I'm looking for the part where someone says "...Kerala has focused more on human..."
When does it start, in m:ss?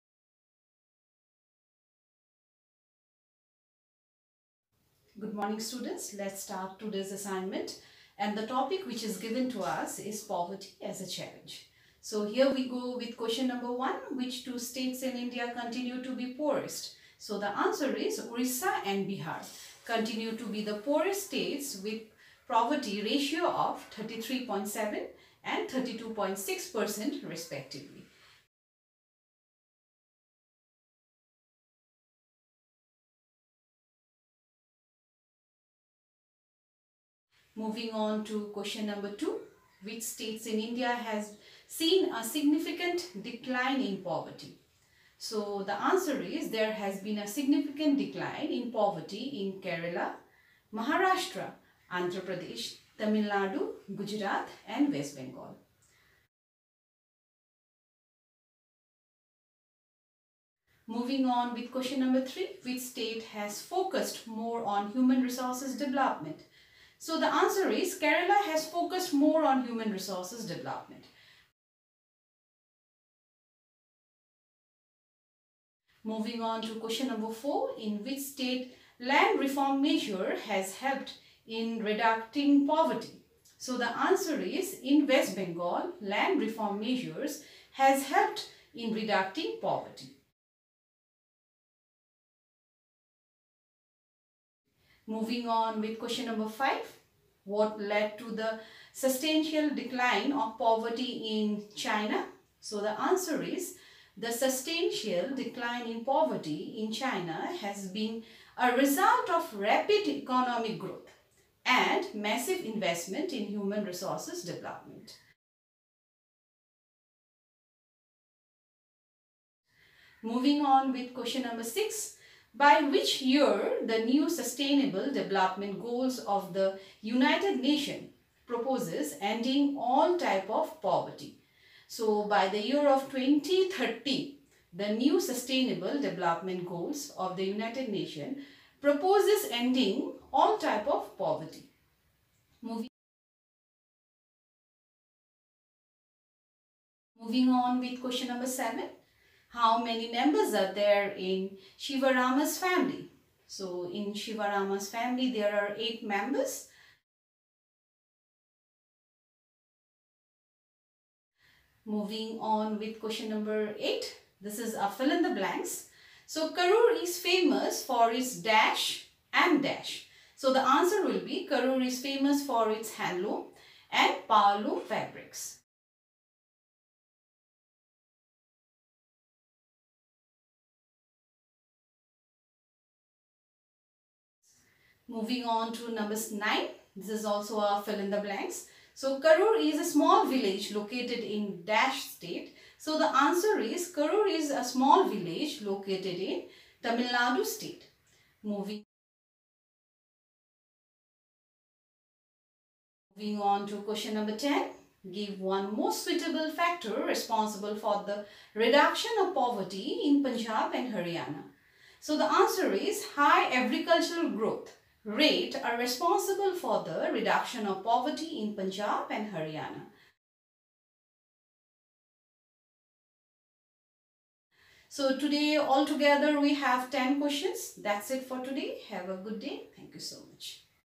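1:07.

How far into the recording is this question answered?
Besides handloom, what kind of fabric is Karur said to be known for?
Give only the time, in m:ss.
2:54.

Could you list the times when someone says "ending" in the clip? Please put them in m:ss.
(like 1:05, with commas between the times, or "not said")
2:09, 2:19.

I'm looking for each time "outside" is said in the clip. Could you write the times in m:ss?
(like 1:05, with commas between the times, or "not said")
not said.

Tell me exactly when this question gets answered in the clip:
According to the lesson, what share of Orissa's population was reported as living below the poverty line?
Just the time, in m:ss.
0:24.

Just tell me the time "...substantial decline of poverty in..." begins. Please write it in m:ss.
1:38.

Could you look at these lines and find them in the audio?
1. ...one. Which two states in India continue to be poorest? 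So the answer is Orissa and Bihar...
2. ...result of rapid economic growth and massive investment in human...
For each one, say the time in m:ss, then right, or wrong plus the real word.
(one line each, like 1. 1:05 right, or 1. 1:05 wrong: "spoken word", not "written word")
1. 0:13 right
2. 1:48 right.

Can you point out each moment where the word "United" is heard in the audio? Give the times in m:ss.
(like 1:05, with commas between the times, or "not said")
2:07, 2:17.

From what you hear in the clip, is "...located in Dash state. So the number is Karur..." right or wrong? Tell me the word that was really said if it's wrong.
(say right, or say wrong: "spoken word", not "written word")
wrong: "answer", not "number".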